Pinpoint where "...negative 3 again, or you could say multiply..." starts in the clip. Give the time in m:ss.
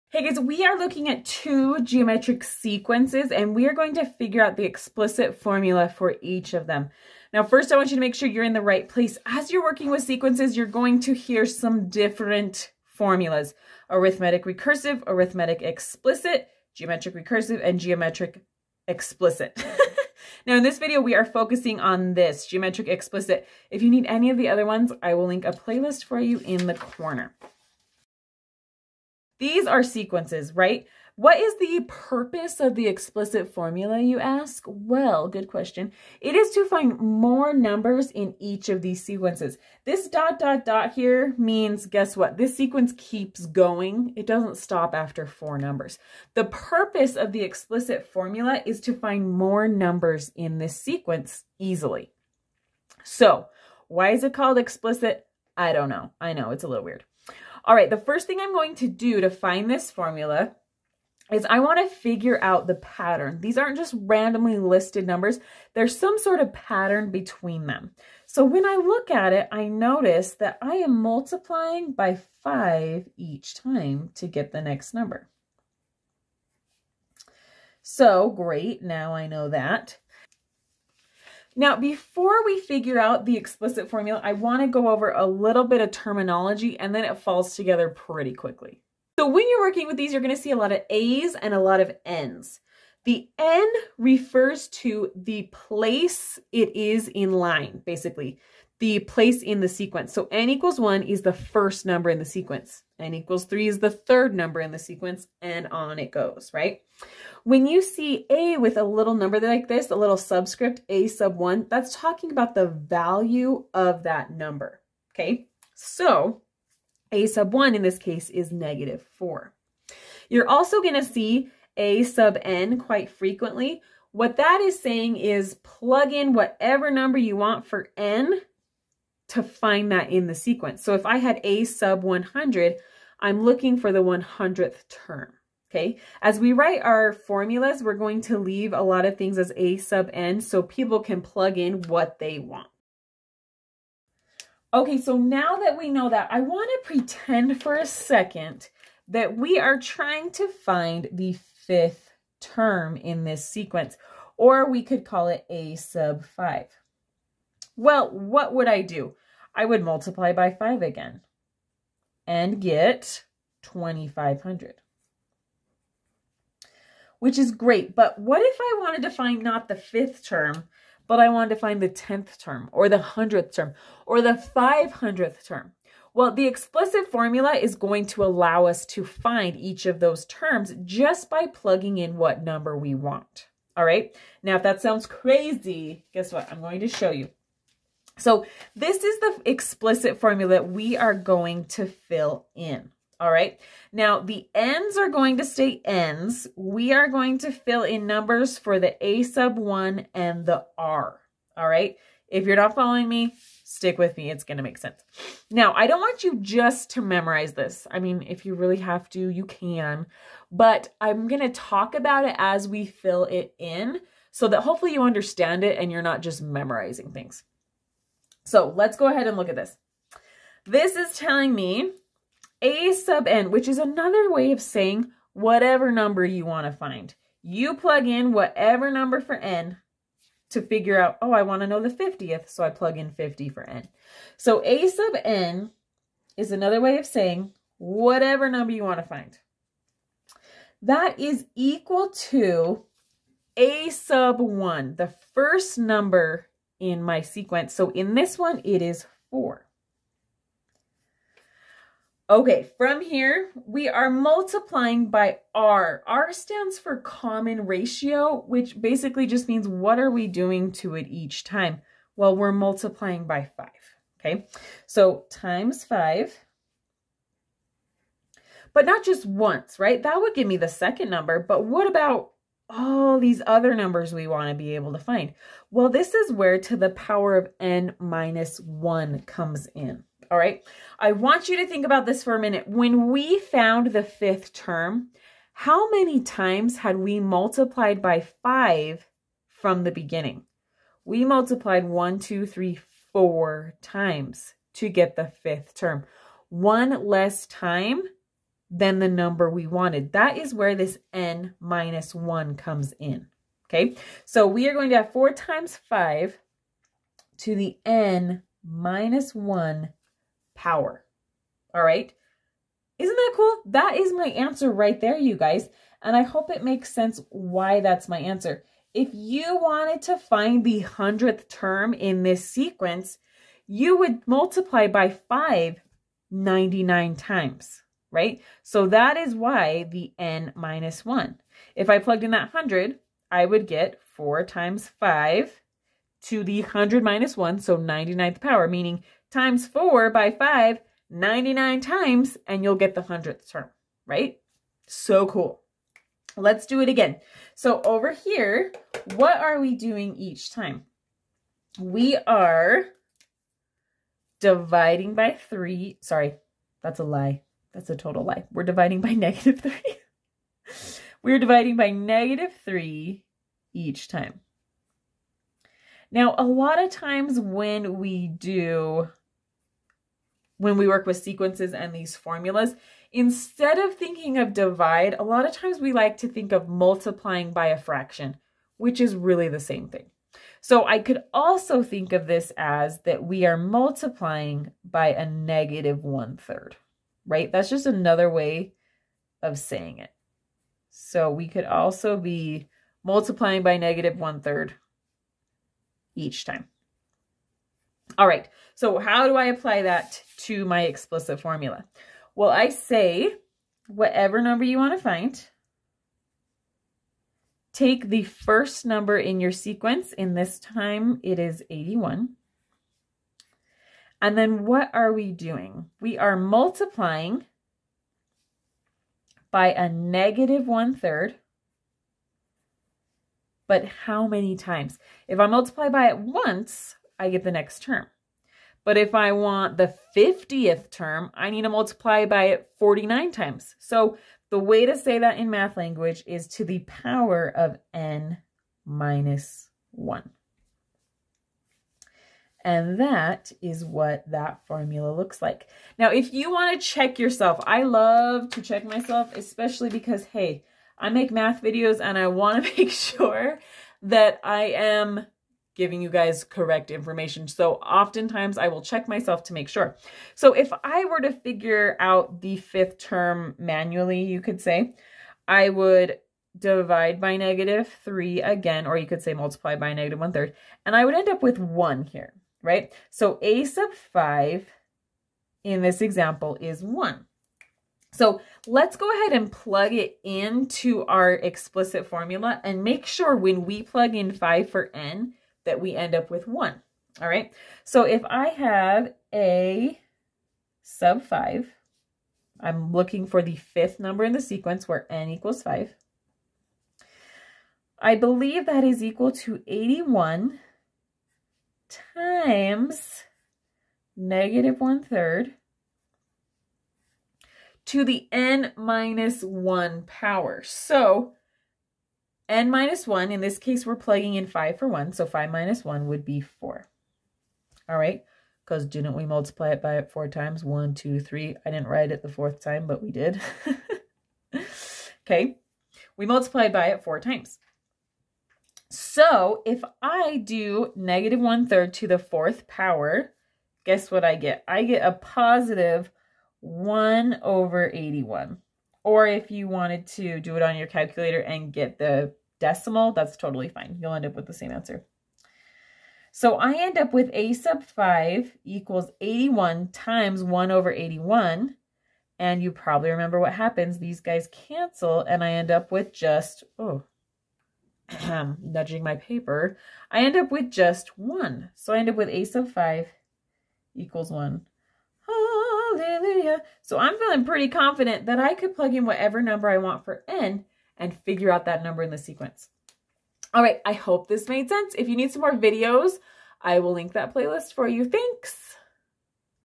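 7:47.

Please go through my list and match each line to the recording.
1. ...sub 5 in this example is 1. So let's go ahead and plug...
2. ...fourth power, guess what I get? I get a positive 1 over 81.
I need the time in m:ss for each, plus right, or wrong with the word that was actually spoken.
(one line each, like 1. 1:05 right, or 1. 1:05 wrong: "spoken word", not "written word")
1. 7:53 right
2. 8:52 right.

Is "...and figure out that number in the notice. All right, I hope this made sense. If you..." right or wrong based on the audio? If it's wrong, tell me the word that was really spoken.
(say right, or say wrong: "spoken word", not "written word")
wrong: "sequence", not "notice".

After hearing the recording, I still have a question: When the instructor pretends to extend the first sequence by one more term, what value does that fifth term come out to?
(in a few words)
2,500.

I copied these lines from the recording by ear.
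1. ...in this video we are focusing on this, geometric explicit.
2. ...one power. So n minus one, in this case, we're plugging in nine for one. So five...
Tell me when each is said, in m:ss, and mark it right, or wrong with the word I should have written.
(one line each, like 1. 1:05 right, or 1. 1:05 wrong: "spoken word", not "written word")
1. 0:20 right
2. 8:29 wrong: "five", not "nine".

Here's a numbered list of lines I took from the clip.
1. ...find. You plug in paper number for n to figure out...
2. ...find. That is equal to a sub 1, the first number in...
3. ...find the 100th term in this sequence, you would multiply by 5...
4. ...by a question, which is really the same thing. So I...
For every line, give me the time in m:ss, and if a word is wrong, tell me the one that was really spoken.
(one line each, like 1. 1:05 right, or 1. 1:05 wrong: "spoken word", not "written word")
1. 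3:46 wrong: "whatever", not "paper"
2. 3:59 right
3. 5:20 right
4. 6:17 wrong: "fraction", not "question".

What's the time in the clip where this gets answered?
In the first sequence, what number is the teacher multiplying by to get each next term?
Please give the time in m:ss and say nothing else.
1:11.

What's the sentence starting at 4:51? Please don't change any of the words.
We multiplied one, two, three, four times to get the fifth term.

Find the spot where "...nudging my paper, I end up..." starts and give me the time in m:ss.
9:18.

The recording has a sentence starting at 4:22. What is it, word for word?
Well, we're multiplying by 5, okay?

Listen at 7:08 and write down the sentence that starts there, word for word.
But if I want the 50th term, I need to multiply by it 49 times.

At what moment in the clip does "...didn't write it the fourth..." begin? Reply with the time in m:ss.
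8:41.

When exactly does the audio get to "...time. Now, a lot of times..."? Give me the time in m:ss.
6:04.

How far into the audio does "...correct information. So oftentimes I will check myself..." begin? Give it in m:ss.
7:36.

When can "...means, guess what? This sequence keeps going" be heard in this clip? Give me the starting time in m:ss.
0:41.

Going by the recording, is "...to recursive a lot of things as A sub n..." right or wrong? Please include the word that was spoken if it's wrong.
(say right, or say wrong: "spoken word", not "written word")
wrong: "leave", not "recursive".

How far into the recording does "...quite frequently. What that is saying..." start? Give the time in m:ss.
2:02.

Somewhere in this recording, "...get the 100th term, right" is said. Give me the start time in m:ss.
5:42.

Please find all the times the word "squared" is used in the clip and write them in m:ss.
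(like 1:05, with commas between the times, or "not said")
not said.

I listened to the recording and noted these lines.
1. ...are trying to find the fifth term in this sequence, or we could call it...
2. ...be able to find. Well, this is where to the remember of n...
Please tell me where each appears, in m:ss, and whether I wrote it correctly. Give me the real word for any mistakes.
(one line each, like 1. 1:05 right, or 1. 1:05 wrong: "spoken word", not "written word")
1. 2:29 right
2. 4:34 wrong: "power", not "remember".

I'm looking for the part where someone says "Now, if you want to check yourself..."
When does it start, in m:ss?
7:25.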